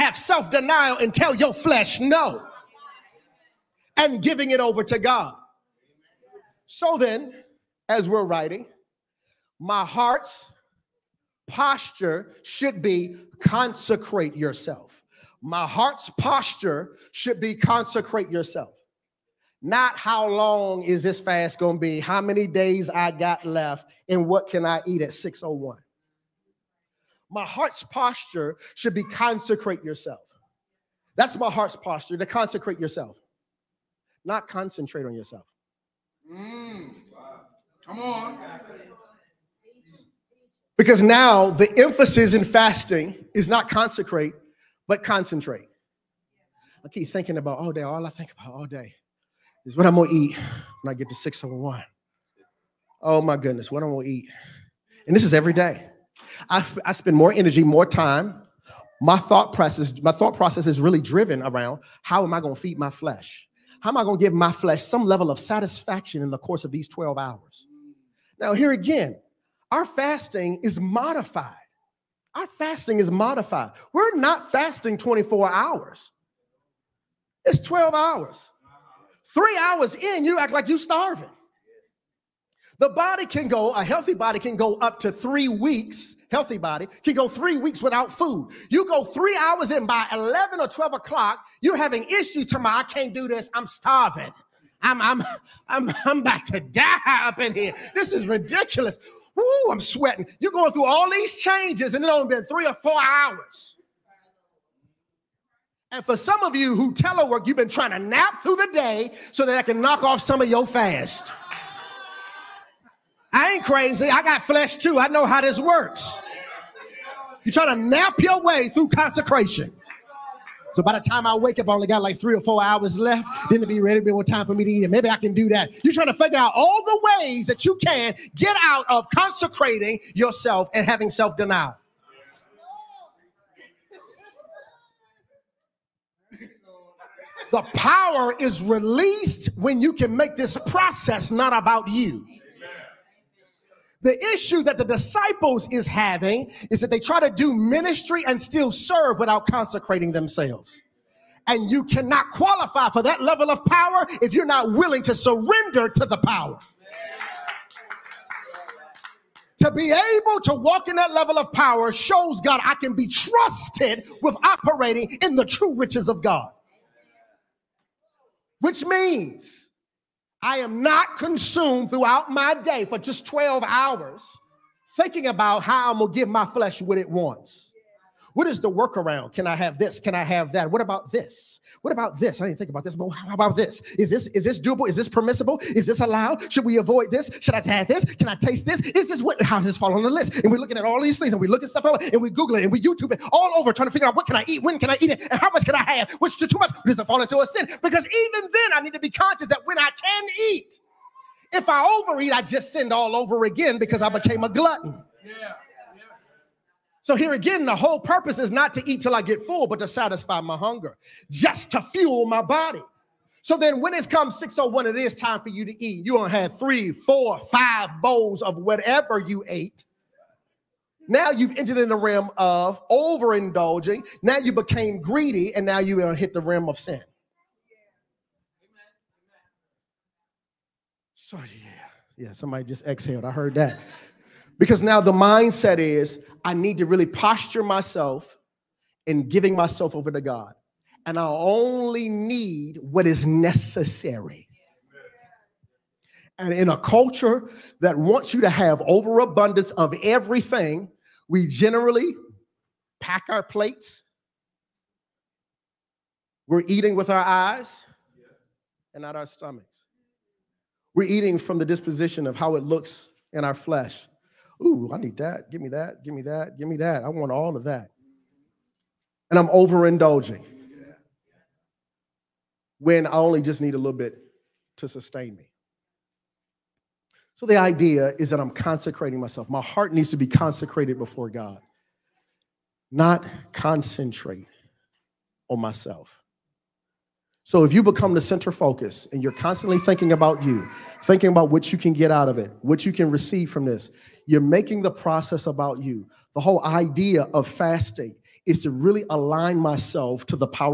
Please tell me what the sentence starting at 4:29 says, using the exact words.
And I'm overindulging when I only just need a little bit to sustain me.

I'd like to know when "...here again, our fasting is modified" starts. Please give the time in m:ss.
1:08.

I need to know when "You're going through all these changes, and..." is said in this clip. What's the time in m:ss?
1:40.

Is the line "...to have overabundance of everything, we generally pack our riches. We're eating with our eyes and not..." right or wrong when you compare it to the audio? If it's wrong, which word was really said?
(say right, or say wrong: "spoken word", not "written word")
wrong: "plates", not "riches".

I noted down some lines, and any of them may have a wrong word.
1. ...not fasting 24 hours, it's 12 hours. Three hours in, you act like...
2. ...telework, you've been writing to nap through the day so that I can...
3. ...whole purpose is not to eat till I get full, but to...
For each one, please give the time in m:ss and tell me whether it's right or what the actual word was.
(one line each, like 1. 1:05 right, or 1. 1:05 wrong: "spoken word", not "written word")
1. 1:14 right
2. 1:46 wrong: "trying", not "writing"
3. 3:27 right.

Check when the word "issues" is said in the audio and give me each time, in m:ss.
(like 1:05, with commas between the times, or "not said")
1:32, 2:24.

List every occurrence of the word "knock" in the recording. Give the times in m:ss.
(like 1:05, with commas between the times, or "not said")
1:49.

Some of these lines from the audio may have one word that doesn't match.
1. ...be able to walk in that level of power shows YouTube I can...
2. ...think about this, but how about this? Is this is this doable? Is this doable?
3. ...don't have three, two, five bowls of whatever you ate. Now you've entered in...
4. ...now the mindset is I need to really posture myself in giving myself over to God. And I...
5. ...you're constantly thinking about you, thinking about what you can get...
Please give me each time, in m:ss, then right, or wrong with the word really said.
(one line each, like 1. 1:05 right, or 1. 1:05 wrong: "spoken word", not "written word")
1. 2:39 wrong: "God", not "YouTube"
2. 3:02 wrong: "permissible", not "doable"
3. 3:36 wrong: "four", not "two"
4. 3:54 right
5. 4:49 right.